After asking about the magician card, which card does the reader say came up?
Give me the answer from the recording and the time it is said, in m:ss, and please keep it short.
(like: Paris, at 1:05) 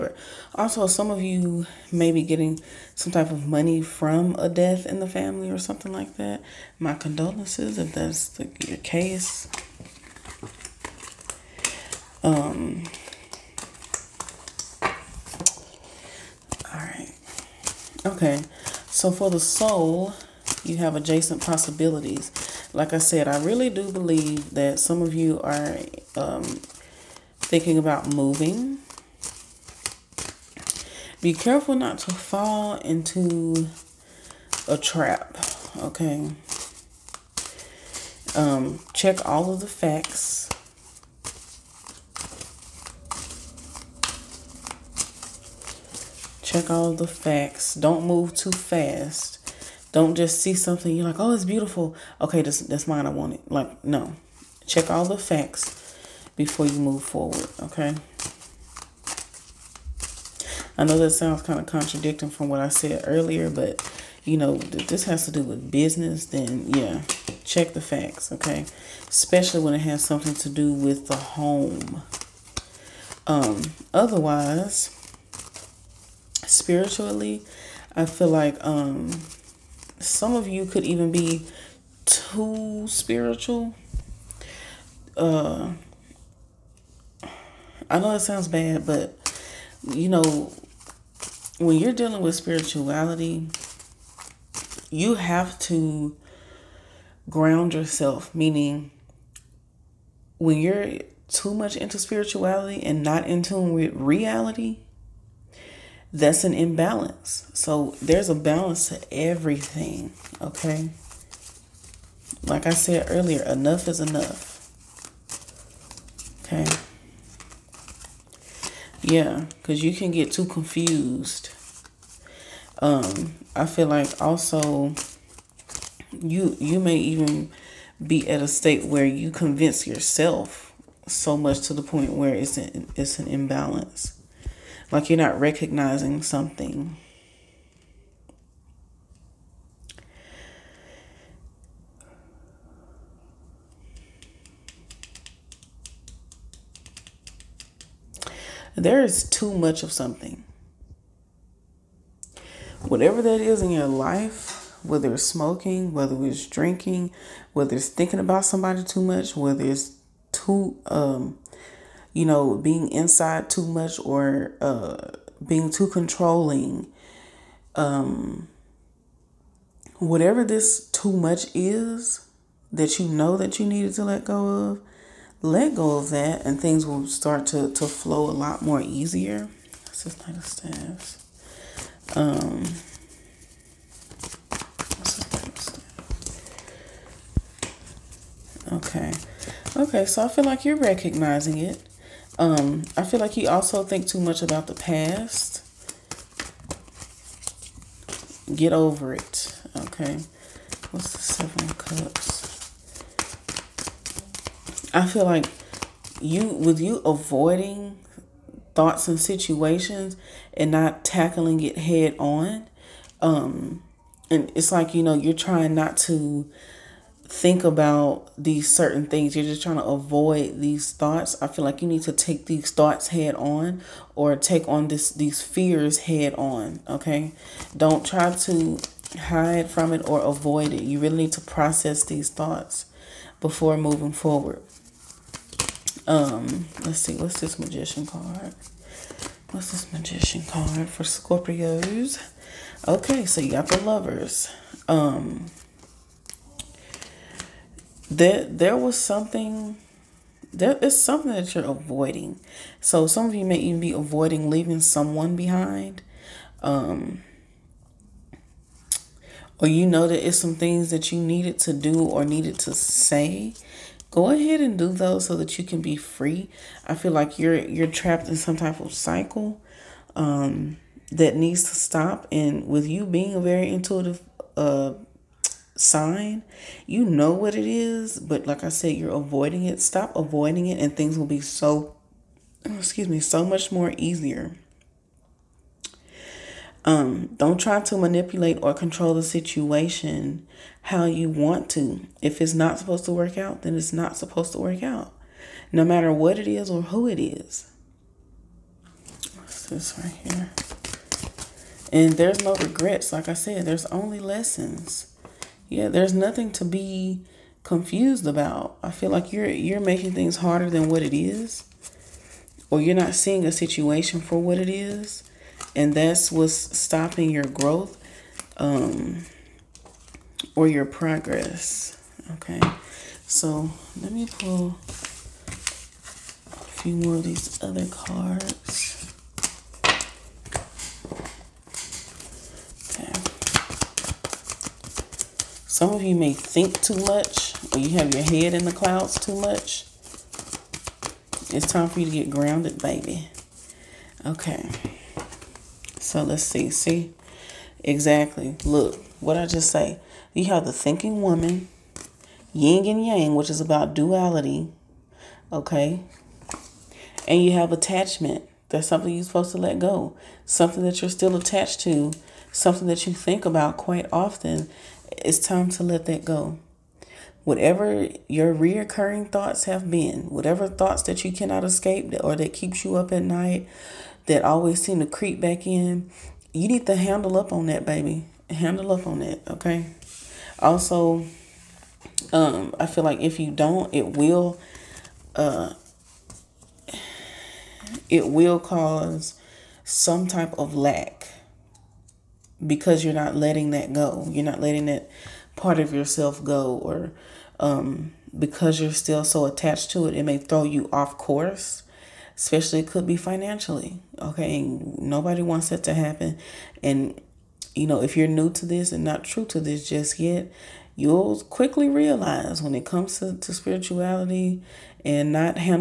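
The Lovers, at 4:03.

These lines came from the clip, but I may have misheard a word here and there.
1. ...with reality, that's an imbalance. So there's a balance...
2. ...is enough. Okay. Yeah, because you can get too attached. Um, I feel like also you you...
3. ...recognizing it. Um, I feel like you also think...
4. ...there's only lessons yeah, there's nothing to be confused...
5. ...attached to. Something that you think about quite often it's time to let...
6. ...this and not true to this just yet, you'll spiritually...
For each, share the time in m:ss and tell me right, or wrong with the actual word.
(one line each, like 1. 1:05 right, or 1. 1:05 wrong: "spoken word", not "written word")
1. 1:43 right
2. 1:53 wrong: "confused", not "attached"
3. 3:10 right
4. 5:03 right
5. 6:01 right
6. 6:48 wrong: "quickly", not "spiritually".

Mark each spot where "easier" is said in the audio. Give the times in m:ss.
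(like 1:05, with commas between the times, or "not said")
2:58, 4:43.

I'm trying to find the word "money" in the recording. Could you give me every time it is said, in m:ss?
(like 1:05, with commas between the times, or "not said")
0:03.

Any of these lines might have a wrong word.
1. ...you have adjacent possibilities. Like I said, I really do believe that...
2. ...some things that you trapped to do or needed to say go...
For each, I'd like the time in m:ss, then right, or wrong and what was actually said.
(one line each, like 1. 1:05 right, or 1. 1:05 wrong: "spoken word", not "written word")
1. 0:20 right
2. 4:20 wrong: "needed", not "trapped".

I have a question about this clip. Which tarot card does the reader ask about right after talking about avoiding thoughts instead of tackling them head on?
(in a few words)
Seven Cups.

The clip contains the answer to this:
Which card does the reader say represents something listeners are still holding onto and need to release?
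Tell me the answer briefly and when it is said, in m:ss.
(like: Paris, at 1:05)
Attachment, at 5:57.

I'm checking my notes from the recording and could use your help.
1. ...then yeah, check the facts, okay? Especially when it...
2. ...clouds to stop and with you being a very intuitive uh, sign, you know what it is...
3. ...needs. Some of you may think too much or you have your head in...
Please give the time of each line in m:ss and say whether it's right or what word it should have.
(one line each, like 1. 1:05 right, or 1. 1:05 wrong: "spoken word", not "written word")
1. 1:06 right
2. 4:31 wrong: "needs", not "clouds"
3. 5:27 wrong: "cards", not "needs".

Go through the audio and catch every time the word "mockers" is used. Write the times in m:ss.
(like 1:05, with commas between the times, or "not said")
not said.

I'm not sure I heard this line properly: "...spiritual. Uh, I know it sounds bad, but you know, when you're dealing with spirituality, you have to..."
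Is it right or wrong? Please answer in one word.
right.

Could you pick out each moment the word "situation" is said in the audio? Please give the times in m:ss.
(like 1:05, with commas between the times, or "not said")
3:29, 4:49, 5:13.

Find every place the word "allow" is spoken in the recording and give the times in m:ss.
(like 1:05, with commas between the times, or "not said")
not said.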